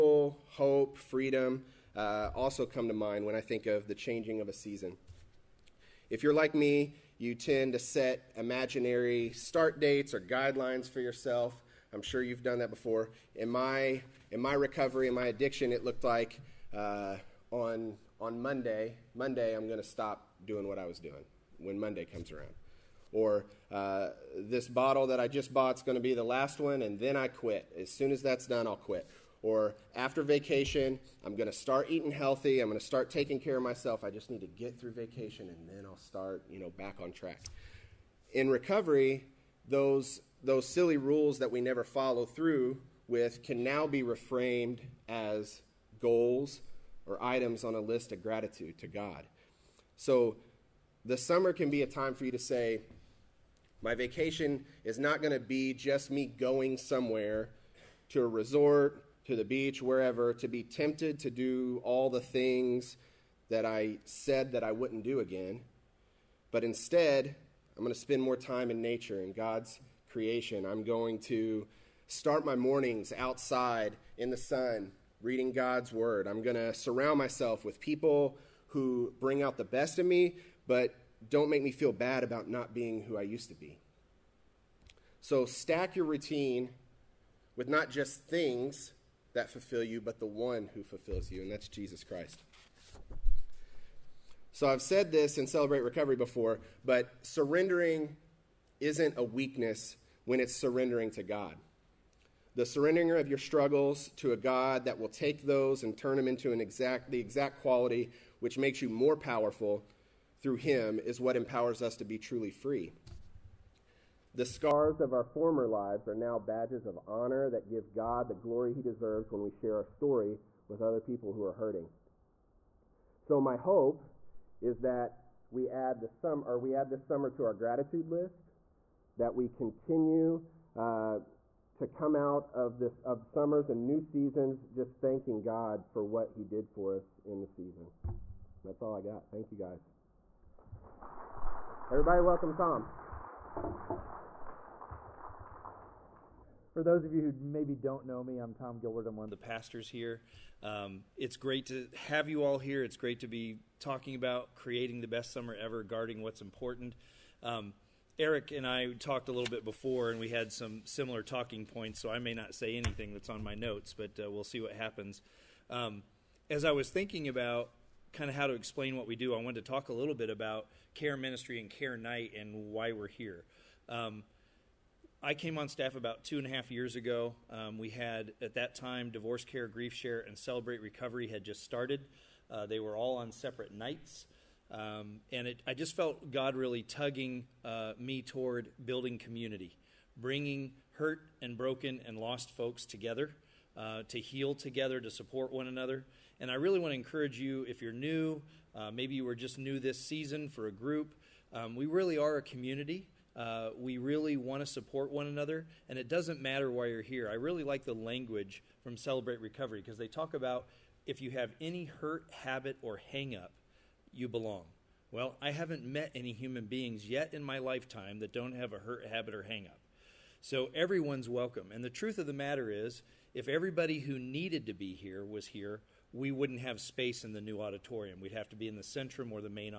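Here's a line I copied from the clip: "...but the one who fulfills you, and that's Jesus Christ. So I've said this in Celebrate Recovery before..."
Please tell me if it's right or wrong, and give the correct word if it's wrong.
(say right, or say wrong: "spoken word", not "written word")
right.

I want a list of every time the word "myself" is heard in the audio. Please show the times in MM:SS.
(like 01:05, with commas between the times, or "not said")
00:33, 01:17.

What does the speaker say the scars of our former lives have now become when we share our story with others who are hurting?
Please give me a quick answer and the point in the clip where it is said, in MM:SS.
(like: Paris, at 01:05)
Badges of honor, at 01:56.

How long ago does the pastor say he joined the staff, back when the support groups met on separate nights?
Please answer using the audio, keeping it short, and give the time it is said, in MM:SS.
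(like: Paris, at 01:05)
2 and a half years, at 02:56.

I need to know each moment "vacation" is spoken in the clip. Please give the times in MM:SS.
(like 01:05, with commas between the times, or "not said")
00:30, 00:34, 00:53.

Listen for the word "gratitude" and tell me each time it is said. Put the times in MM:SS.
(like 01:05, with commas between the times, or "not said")
00:48, 02:07.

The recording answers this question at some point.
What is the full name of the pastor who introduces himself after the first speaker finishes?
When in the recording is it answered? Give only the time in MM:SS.
02:28.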